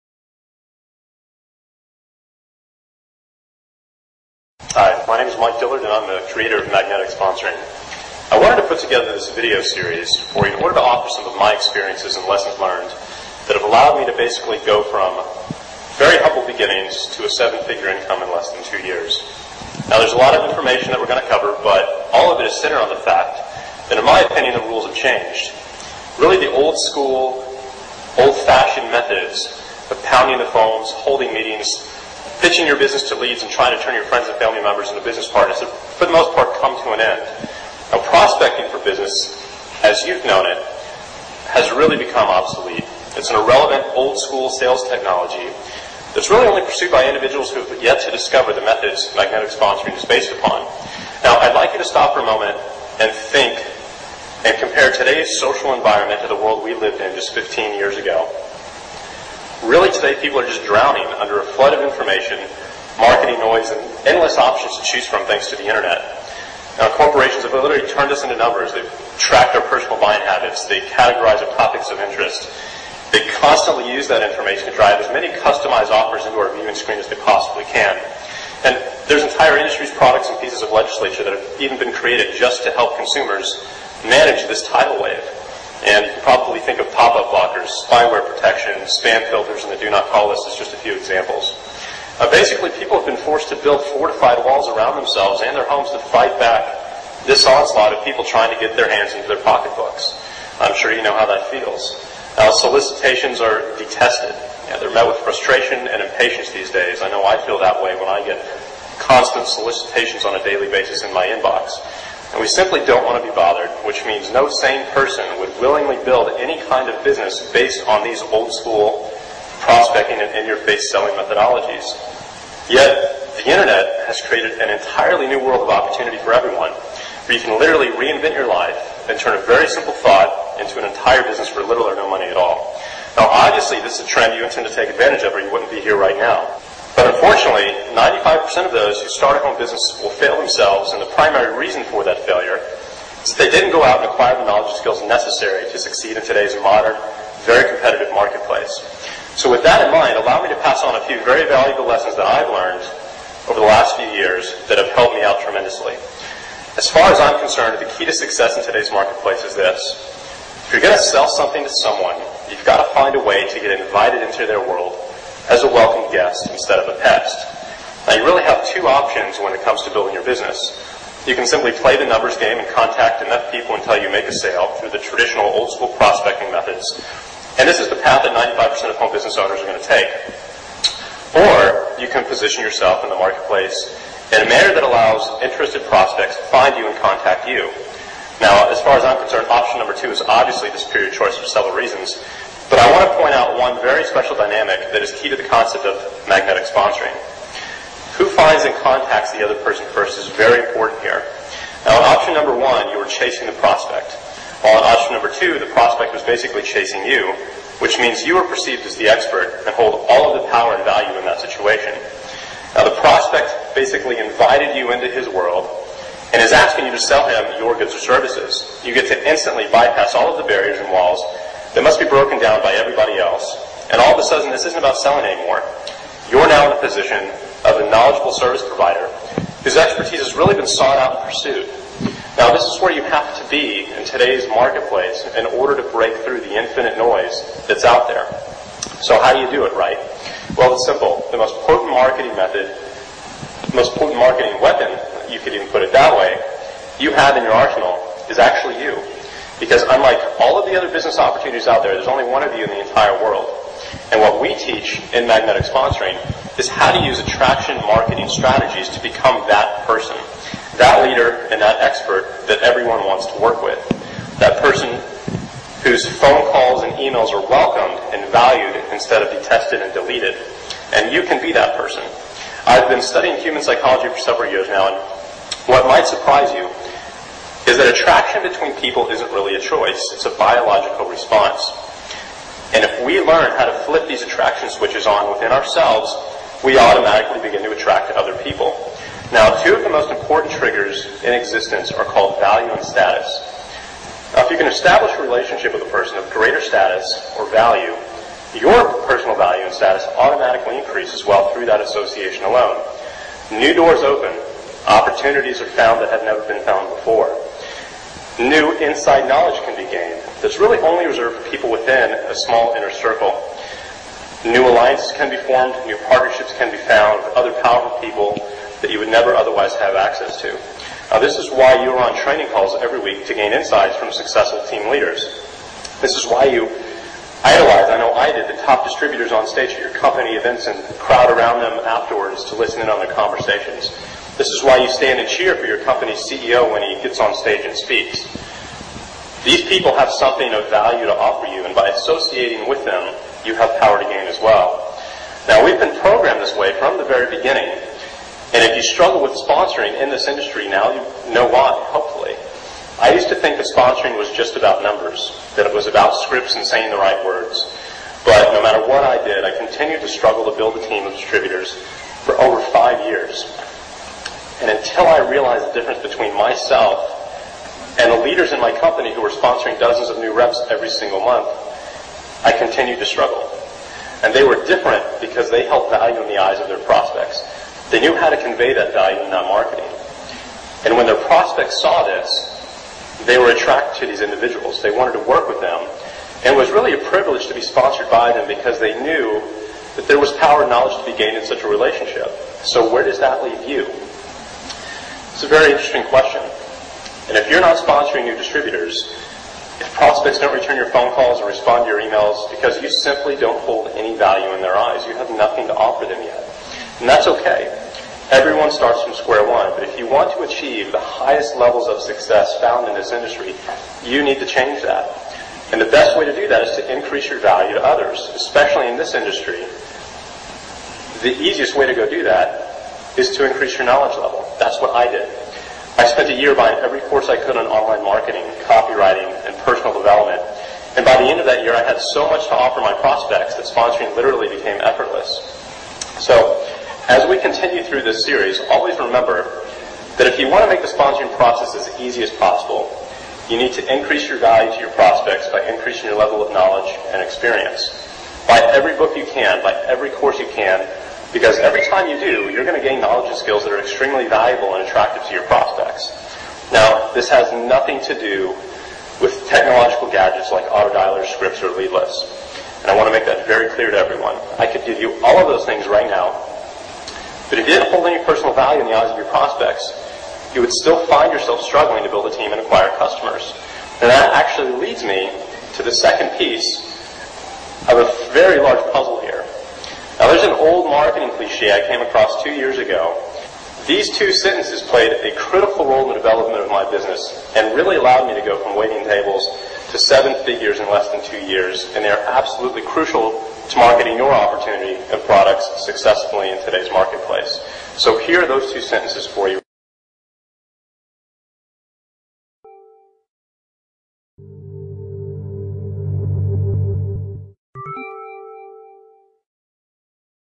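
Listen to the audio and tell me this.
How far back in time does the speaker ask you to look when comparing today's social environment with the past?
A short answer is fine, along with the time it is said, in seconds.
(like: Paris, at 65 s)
15 years, at 57 s.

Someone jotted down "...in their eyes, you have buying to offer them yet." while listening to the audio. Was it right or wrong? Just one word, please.
wrong.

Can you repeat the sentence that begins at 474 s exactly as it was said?
And that actually leads me to the second piece of a very large puzzle marketing cliche I came across two years ago.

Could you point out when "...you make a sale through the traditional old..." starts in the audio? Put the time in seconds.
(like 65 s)
174 s.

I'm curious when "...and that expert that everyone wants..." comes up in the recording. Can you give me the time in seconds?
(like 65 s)
261 s.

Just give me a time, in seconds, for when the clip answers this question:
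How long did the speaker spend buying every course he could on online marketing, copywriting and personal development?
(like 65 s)
426 s.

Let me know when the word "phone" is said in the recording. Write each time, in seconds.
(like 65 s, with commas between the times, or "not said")
30 s, 266 s, 400 s.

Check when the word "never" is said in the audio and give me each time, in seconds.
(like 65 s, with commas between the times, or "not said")
306 s, 319 s.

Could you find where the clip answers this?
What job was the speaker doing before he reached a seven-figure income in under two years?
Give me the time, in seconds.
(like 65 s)
488 s.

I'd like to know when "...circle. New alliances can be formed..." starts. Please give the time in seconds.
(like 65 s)
312 s.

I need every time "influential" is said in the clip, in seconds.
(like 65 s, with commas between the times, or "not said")
not said.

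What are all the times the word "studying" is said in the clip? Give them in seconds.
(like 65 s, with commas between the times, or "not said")
273 s.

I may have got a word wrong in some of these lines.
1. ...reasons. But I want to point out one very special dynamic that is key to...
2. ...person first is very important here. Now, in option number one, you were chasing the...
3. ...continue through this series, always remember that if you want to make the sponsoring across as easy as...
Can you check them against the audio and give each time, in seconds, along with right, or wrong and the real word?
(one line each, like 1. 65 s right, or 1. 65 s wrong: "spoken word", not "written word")
1. 191 s right
2. 199 s right
3. 437 s wrong: "process", not "across".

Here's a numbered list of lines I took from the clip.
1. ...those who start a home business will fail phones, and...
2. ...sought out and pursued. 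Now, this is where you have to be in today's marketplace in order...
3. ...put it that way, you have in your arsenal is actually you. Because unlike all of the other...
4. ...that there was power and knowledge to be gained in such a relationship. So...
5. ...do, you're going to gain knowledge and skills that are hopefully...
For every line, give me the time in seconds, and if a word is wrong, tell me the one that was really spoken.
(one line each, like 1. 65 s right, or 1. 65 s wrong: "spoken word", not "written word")
1. 138 s wrong: "themselves", not "phones"
2. 230 s right
3. 245 s right
4. 389 s right
5. 452 s wrong: "extremely", not "hopefully".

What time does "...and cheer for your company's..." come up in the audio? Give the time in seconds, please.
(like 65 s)
335 s.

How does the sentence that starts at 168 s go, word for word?
Now you really have two options when it comes to building your business.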